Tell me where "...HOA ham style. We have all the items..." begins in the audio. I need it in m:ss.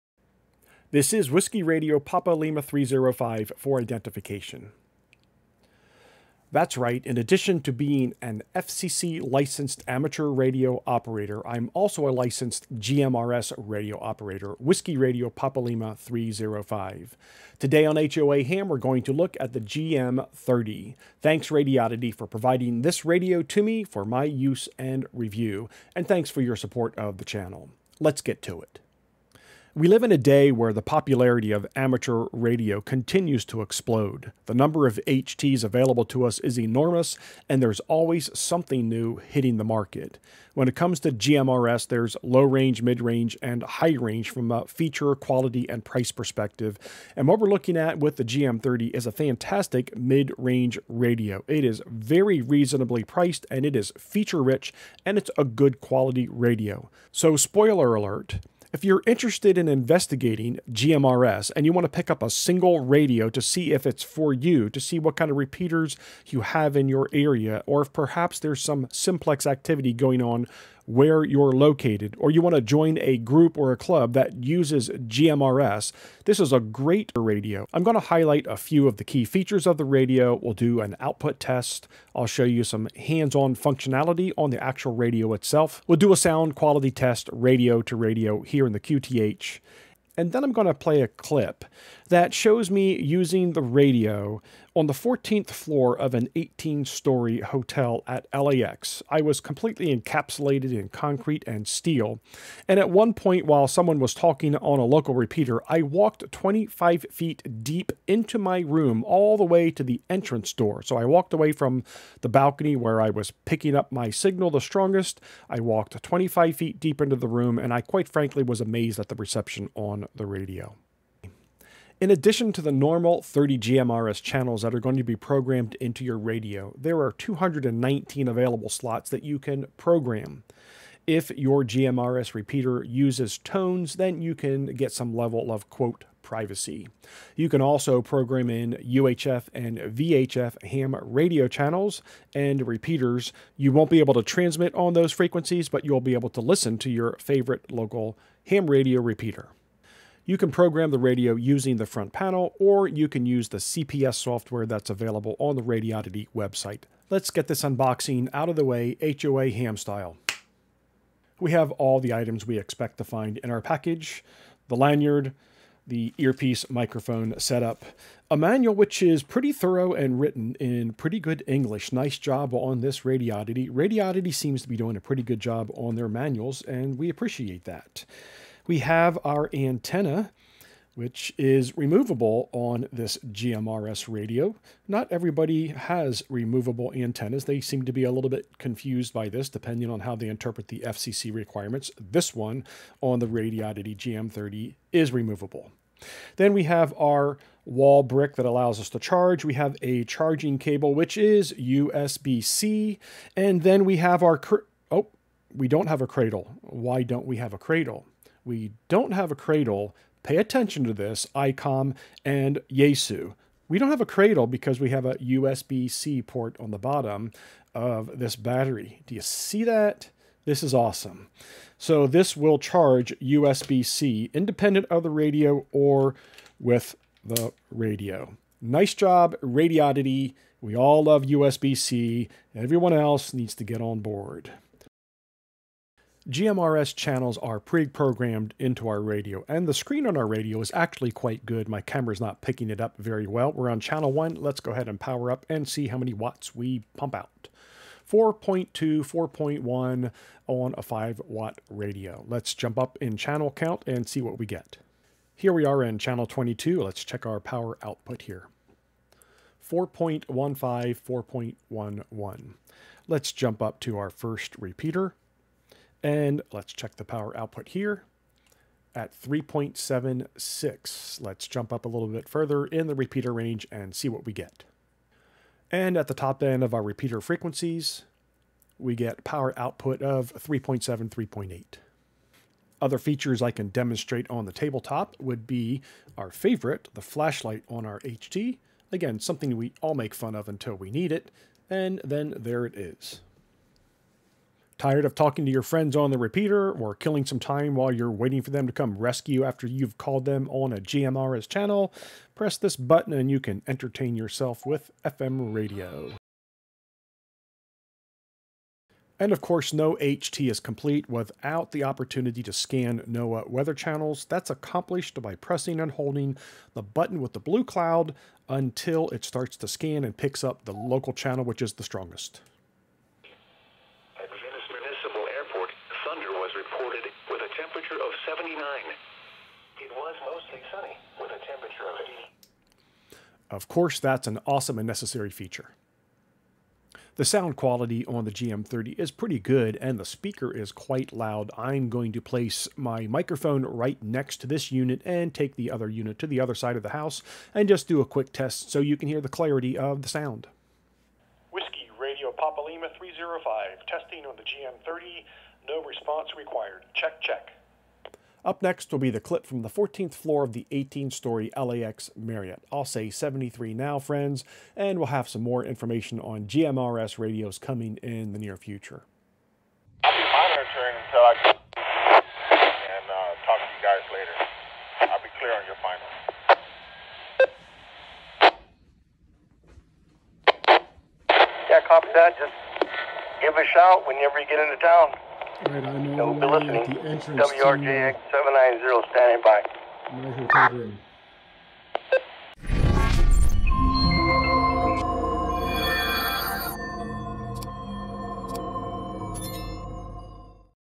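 2:39.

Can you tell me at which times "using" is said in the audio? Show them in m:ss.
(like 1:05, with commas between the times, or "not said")
1:33, 2:31.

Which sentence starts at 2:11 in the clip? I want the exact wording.
If your GMRS repeater uses tones, then you can get some level of quote privacy.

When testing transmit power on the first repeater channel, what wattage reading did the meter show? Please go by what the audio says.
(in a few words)
3.76.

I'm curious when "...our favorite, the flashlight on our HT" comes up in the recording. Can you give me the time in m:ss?
4:46.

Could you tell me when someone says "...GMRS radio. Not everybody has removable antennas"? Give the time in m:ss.
3:03.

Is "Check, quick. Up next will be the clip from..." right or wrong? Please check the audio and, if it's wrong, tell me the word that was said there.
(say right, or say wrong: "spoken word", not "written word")
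wrong: "check", not "quick".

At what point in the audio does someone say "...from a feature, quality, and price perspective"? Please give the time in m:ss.
0:44.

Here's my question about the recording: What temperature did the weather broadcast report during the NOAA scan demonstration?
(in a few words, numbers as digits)
80.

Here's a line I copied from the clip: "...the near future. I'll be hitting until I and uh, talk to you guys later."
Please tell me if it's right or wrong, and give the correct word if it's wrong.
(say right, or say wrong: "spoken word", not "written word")
wrong: "monitoring", not "hitting".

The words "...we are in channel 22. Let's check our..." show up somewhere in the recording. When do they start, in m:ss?
4:15.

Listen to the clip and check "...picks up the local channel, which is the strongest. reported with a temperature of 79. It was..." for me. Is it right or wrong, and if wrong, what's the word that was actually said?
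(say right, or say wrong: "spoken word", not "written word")
right.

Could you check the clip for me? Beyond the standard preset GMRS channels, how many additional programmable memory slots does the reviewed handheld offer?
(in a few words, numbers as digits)
219.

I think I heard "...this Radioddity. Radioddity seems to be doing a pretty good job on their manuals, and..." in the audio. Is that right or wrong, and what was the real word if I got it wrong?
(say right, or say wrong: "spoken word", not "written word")
right.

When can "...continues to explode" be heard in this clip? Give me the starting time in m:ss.
0:32.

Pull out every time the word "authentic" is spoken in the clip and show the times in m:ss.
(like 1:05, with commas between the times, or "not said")
not said.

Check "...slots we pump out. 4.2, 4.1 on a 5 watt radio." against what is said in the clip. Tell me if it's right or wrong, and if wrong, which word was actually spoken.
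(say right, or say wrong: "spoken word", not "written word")
wrong: "watts", not "slots".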